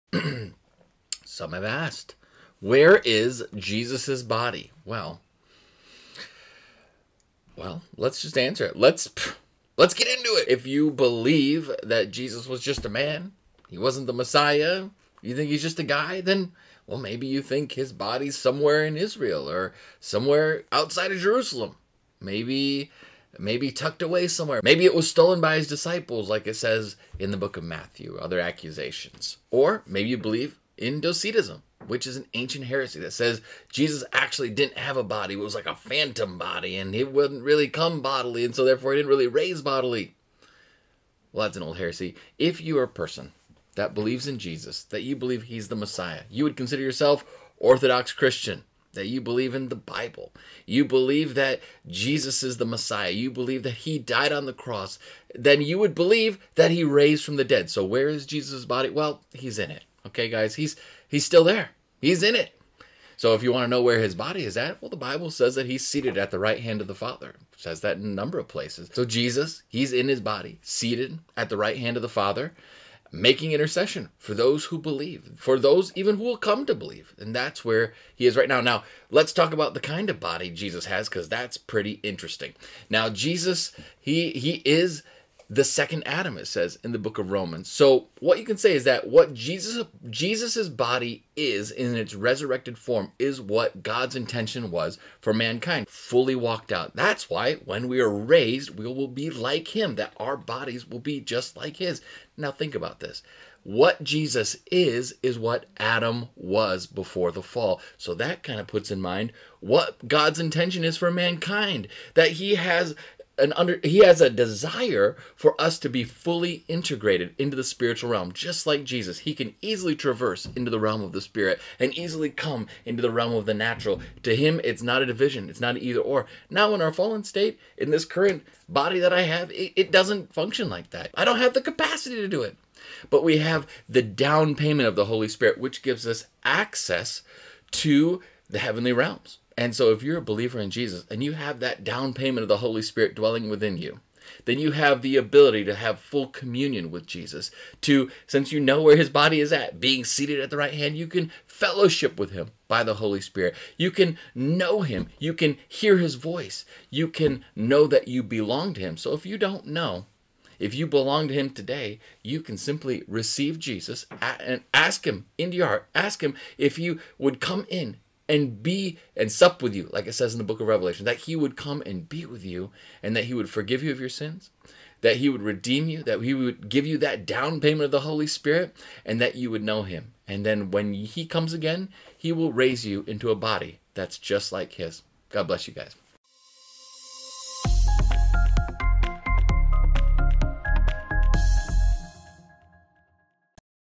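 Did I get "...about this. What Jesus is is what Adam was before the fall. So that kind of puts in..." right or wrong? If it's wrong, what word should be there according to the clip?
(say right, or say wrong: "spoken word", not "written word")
right.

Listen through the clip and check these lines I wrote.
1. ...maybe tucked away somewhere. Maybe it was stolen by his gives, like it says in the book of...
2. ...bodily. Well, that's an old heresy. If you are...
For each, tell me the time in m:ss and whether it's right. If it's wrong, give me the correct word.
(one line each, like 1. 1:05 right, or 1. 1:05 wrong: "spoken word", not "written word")
1. 0:23 wrong: "disciples", not "gives"
2. 0:39 right.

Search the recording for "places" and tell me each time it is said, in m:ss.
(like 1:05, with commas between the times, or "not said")
1:08.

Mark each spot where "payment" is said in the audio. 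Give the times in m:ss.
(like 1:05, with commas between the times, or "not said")
2:14, 2:22, 2:57.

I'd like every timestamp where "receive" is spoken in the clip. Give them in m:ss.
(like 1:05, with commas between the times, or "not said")
2:43.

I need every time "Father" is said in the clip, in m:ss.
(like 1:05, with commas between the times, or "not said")
1:06, 1:12.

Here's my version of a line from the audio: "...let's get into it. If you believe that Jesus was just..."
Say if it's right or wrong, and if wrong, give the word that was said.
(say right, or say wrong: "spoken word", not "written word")
right.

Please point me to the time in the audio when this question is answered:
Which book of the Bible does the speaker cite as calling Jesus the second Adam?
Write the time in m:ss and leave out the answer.
1:27.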